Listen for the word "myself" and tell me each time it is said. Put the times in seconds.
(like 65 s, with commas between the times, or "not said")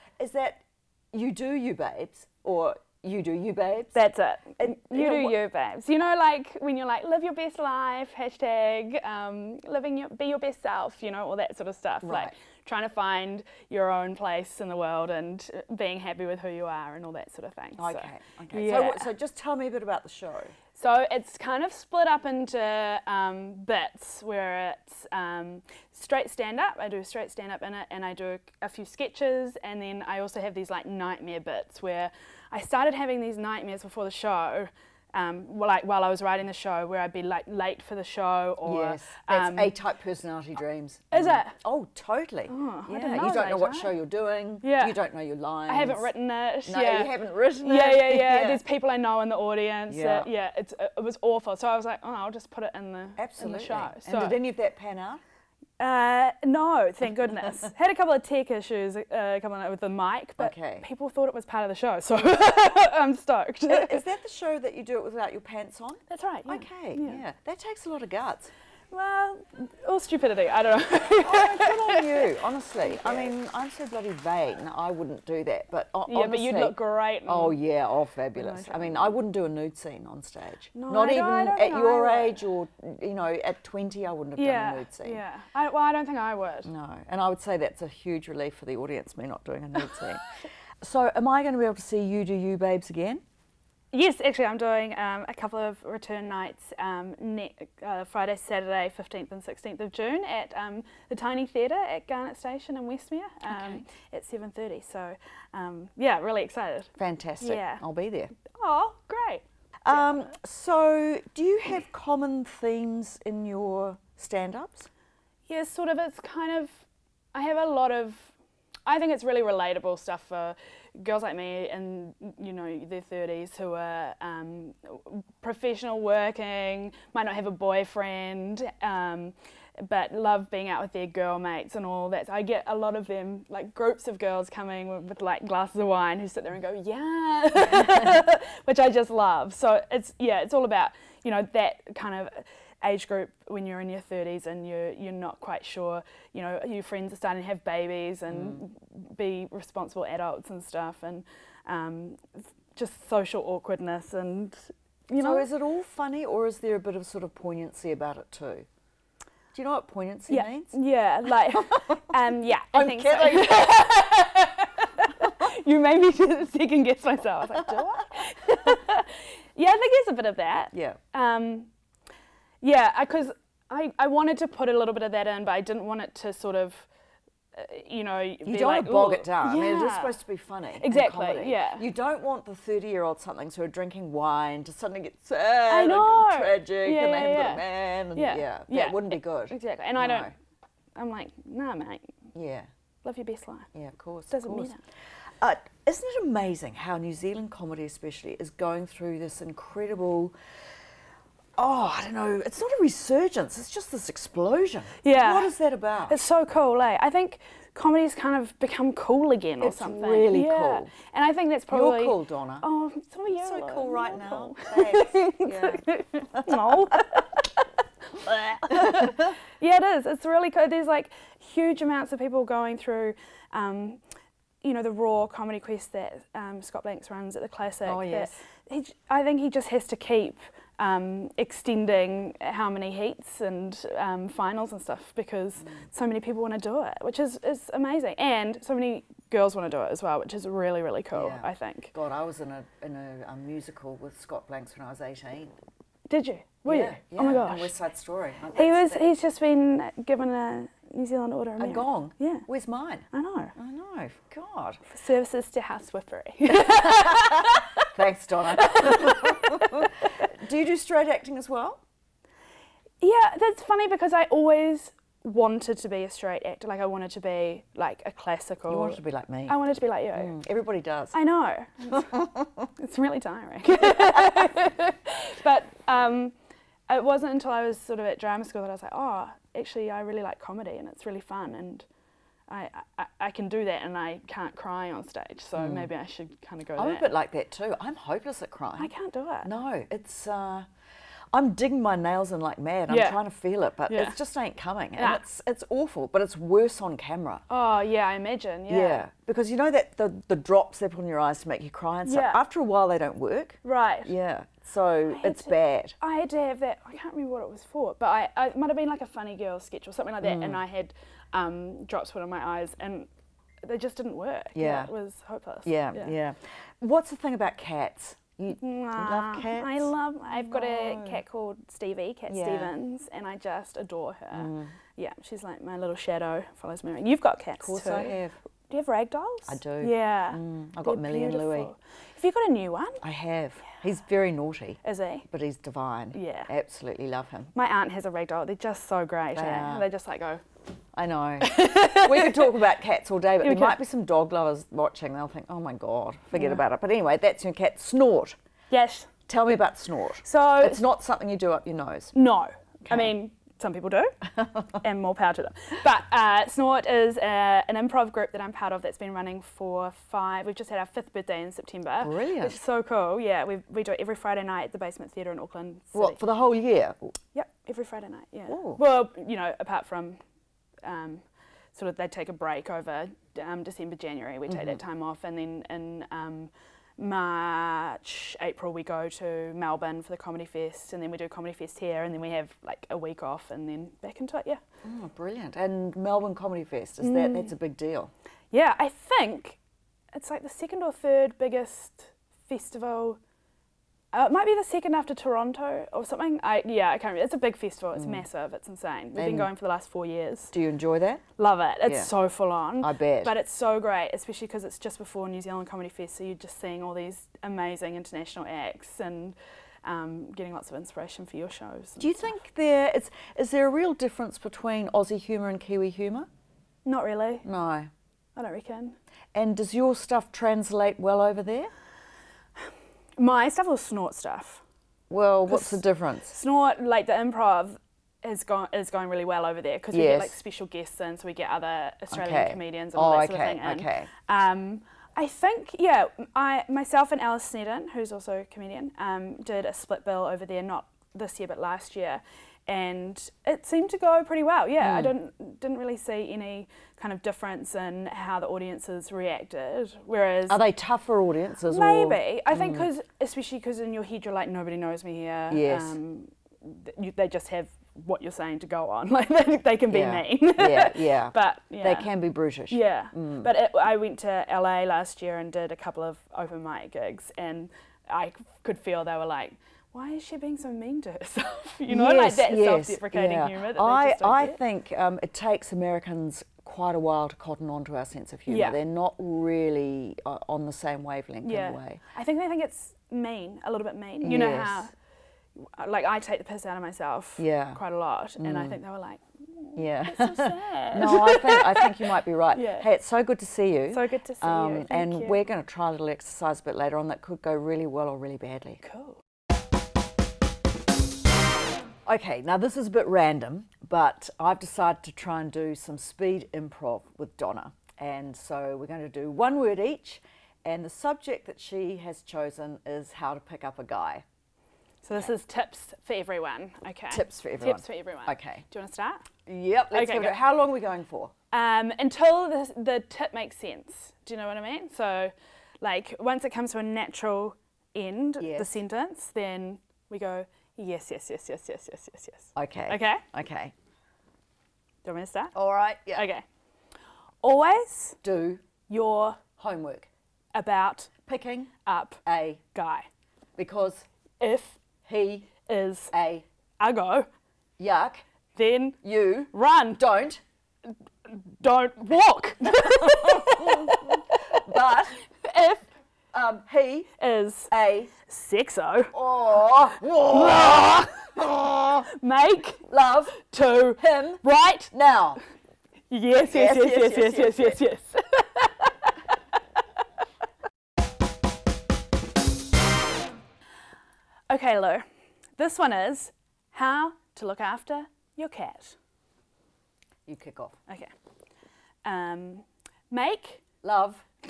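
167 s, 436 s, 486 s.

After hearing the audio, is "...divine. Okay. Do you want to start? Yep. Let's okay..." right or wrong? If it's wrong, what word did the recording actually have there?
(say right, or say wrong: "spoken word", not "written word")
wrong: "everyone", not "divine".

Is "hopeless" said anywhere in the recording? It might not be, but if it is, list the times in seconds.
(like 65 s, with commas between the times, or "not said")
287 s, 315 s.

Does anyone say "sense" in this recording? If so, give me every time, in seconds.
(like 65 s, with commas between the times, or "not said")
478 s, 523 s.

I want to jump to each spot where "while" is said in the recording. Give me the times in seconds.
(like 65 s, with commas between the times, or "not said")
35 s, 302 s, 476 s.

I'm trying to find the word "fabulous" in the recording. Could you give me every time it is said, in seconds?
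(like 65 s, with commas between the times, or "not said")
78 s.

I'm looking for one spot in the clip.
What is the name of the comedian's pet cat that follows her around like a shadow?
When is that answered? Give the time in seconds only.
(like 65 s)
321 s.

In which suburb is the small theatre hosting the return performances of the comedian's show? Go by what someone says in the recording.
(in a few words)
Westmere.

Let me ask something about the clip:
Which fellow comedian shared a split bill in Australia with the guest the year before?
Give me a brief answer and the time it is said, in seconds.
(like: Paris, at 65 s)
Alice Sneddon, at 437 s.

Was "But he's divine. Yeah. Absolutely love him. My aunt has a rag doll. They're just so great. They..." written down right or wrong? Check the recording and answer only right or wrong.
right.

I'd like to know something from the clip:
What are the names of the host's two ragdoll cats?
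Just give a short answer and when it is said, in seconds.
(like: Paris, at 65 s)
Millie and Louie, at 330 s.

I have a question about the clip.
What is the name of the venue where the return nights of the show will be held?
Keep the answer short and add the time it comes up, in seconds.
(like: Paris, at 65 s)
Tiny Theatre, at 101 s.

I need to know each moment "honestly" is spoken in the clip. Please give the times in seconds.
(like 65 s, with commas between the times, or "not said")
72 s.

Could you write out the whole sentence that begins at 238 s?
And so many girls want to do it as well, which is really, really cool, yeah.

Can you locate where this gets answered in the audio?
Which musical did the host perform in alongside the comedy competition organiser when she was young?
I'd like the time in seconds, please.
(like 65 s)
247 s.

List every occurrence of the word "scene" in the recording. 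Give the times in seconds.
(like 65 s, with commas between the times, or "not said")
79 s, 84 s, 90 s.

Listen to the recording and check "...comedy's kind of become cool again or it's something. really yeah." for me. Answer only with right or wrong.
right.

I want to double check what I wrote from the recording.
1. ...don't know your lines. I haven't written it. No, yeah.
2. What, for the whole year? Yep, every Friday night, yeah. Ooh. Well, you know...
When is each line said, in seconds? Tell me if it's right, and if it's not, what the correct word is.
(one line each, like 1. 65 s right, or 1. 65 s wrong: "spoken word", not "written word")
1. 44 s right
2. 365 s right.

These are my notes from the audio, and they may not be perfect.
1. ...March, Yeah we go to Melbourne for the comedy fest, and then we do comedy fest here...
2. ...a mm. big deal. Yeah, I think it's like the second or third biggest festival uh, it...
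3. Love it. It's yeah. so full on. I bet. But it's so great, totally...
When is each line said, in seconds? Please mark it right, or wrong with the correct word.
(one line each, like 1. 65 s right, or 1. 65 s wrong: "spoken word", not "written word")
1. 376 s wrong: "April", not "Yeah"
2. 387 s right
3. 401 s wrong: "especially", not "totally".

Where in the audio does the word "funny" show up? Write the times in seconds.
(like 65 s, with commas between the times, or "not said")
155 s, 180 s, 263 s, 309 s.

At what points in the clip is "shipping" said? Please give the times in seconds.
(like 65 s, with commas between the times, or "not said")
not said.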